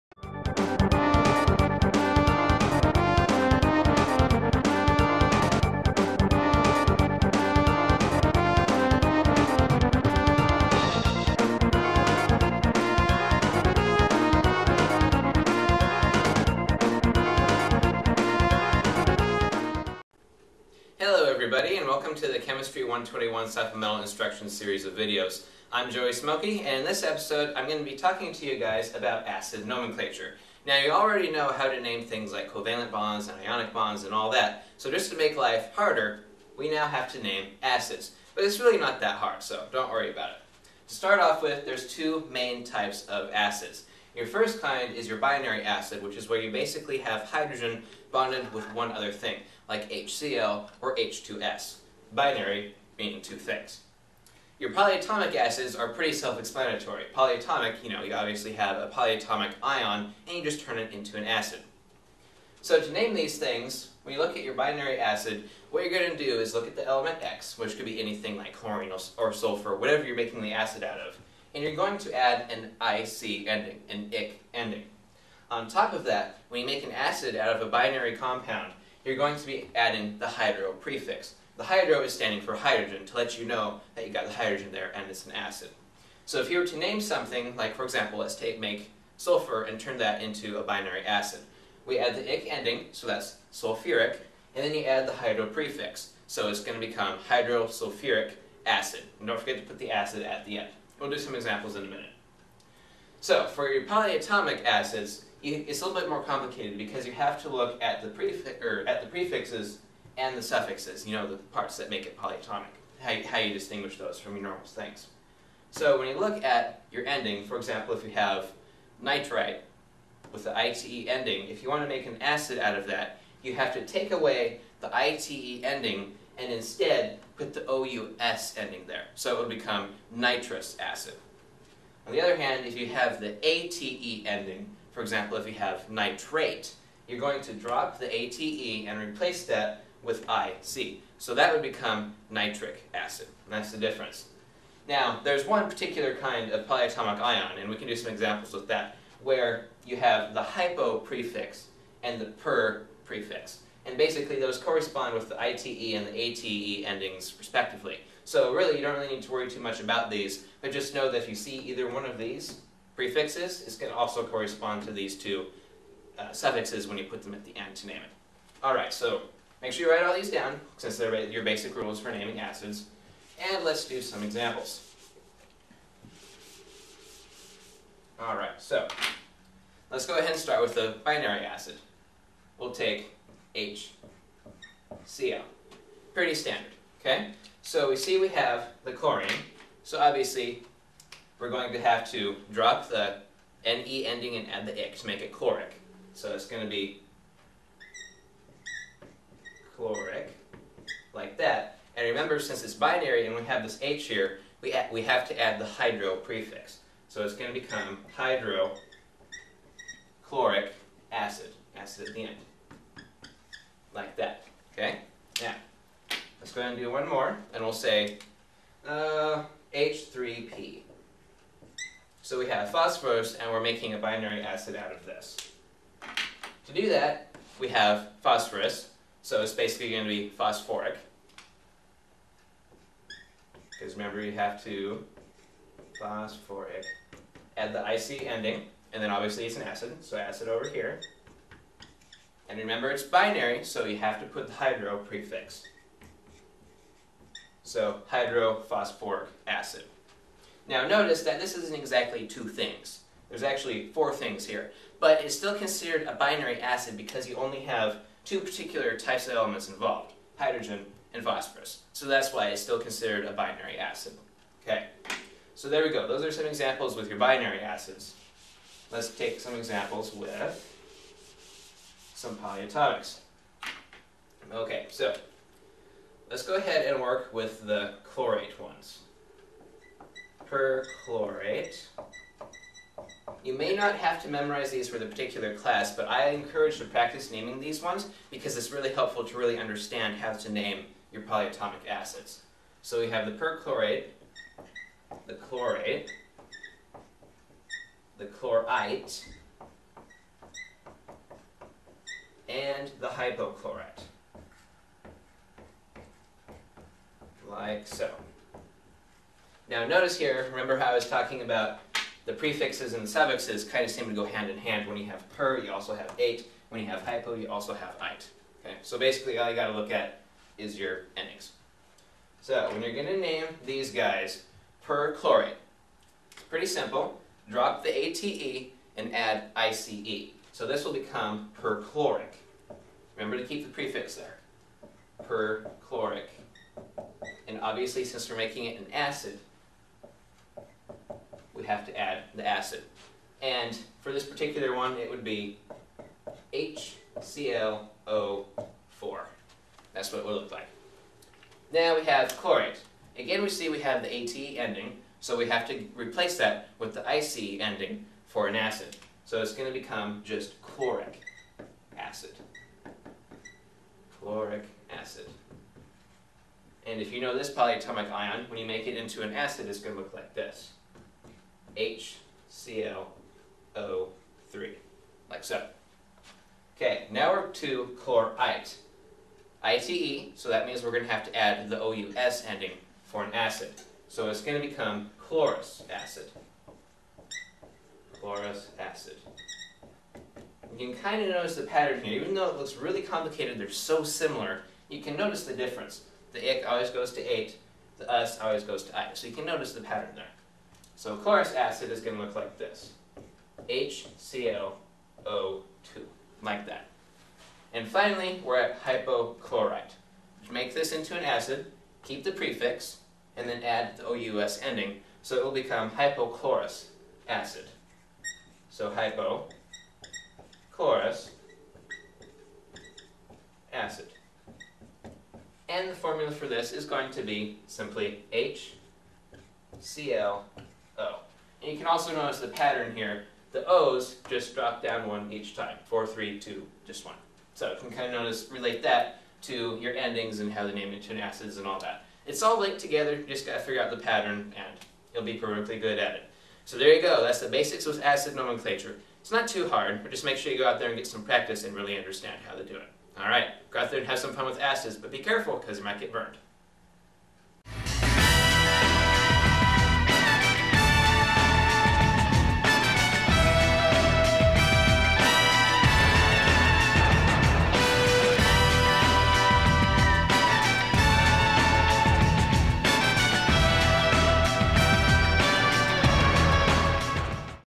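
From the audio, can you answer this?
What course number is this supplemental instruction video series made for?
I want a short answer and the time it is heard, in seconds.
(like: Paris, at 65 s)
Chemistry 121, at 22 s.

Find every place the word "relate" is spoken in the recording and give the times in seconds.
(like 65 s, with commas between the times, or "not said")
438 s.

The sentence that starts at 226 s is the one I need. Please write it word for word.
To do that, we have phosphorus, so it's basically going to be phosphoric.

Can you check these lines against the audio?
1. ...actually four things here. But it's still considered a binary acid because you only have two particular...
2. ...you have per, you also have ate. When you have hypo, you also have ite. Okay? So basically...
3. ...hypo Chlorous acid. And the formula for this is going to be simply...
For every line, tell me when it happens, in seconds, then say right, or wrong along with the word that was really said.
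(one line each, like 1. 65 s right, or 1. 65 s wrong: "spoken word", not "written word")
1. 253 s right
2. 314 s right
3. 418 s right.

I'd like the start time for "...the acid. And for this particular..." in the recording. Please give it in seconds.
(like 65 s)
342 s.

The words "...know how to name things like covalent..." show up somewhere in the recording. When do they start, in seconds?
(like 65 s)
31 s.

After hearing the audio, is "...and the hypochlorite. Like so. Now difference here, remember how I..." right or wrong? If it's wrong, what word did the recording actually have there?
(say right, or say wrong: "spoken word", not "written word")
wrong: "notice", not "difference".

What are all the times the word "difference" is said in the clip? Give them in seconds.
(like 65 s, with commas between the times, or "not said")
143 s, 395 s.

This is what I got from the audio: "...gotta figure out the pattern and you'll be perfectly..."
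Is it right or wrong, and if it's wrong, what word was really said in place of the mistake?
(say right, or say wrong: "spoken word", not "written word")
right.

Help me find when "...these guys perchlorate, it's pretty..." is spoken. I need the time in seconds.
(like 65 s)
323 s.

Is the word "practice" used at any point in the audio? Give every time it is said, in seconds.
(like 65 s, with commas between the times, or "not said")
286 s, 451 s.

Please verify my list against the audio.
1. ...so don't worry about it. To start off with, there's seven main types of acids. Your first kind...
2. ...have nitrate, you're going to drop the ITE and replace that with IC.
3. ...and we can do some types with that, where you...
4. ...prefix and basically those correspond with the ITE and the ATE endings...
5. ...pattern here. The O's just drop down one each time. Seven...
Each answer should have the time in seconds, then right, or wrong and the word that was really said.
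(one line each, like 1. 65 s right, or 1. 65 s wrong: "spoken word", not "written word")
1. 39 s wrong: "two", not "seven"
2. 135 s wrong: "ATE", not "ITE"
3. 147 s wrong: "examples", not "types"
4. 153 s right
5. 432 s wrong: "Four", not "Seven".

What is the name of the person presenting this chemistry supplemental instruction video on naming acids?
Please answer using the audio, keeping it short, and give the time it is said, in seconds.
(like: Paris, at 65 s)
Joey Smokey, at 25 s.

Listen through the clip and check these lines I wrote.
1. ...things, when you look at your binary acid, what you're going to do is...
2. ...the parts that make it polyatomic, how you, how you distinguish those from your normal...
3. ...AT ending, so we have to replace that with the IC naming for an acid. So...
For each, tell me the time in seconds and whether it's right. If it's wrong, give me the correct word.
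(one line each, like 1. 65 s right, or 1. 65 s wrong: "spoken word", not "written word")
1. 63 s right
2. 111 s right
3. 354 s wrong: "ending", not "naming".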